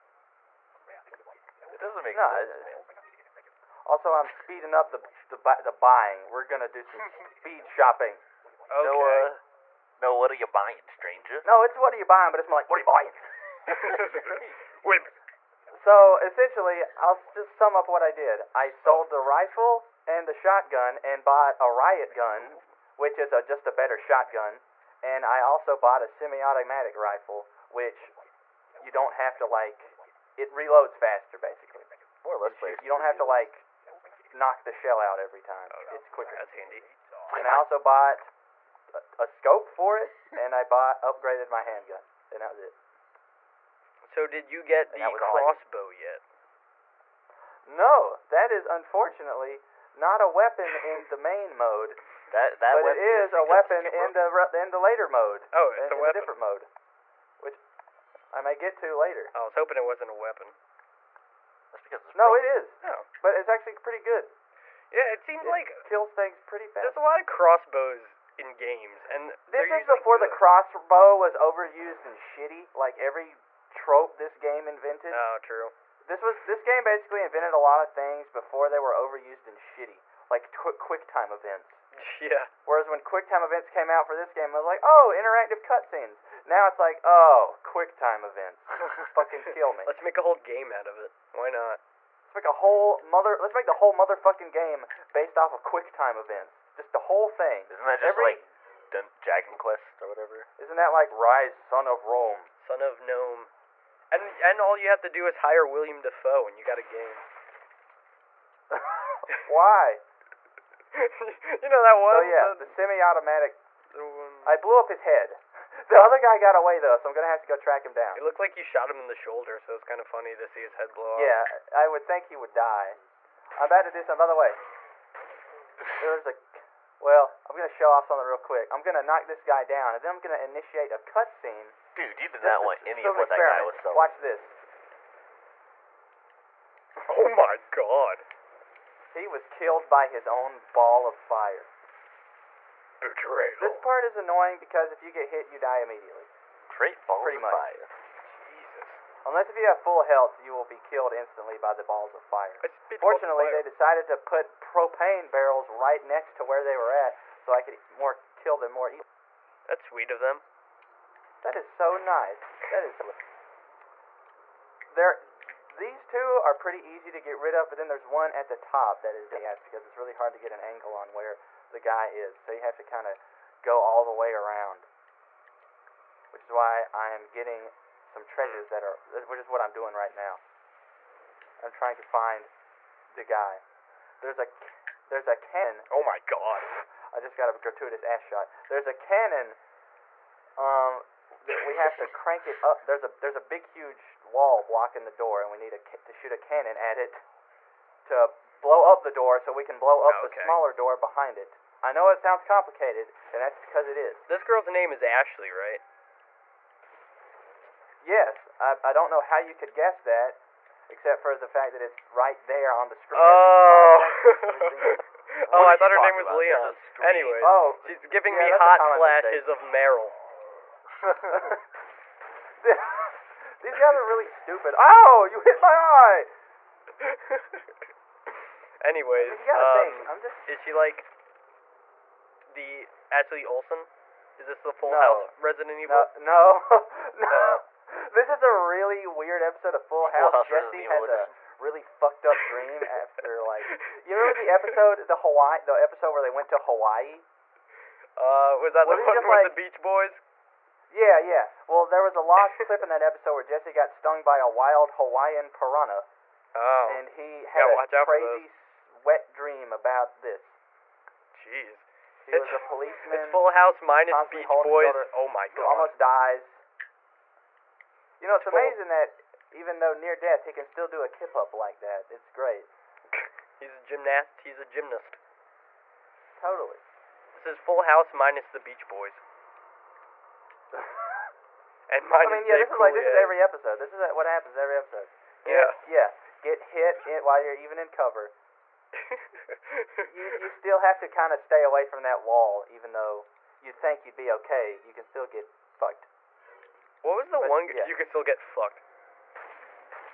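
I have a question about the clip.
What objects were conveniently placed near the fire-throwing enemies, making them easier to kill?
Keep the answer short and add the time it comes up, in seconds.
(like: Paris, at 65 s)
propane barrels, at 154 s.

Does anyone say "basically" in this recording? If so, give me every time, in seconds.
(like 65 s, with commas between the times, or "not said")
31 s, 76 s.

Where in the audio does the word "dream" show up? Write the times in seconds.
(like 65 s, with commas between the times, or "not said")
242 s, 259 s.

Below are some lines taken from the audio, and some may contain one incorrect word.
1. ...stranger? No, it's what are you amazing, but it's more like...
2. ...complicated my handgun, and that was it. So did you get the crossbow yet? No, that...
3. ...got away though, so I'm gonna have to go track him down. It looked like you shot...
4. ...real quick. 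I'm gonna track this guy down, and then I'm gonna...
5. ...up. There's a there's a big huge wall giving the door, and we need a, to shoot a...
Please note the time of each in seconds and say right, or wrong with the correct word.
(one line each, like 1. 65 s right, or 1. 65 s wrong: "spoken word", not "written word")
1. 10 s wrong: "buying", not "amazing"
2. 41 s wrong: "upgraded", not "complicated"
3. 116 s right
4. 128 s wrong: "knock", not "track"
5. 192 s wrong: "blocking", not "giving".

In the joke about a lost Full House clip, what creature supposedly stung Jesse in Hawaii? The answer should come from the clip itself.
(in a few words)
wild Hawaiian piranha.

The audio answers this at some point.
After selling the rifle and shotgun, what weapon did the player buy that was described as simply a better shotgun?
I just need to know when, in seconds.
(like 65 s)
21 s.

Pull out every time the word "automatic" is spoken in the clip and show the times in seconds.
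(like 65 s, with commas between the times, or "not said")
26 s, 112 s.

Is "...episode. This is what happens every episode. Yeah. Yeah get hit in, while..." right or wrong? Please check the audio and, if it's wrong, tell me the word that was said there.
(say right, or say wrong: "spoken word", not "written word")
right.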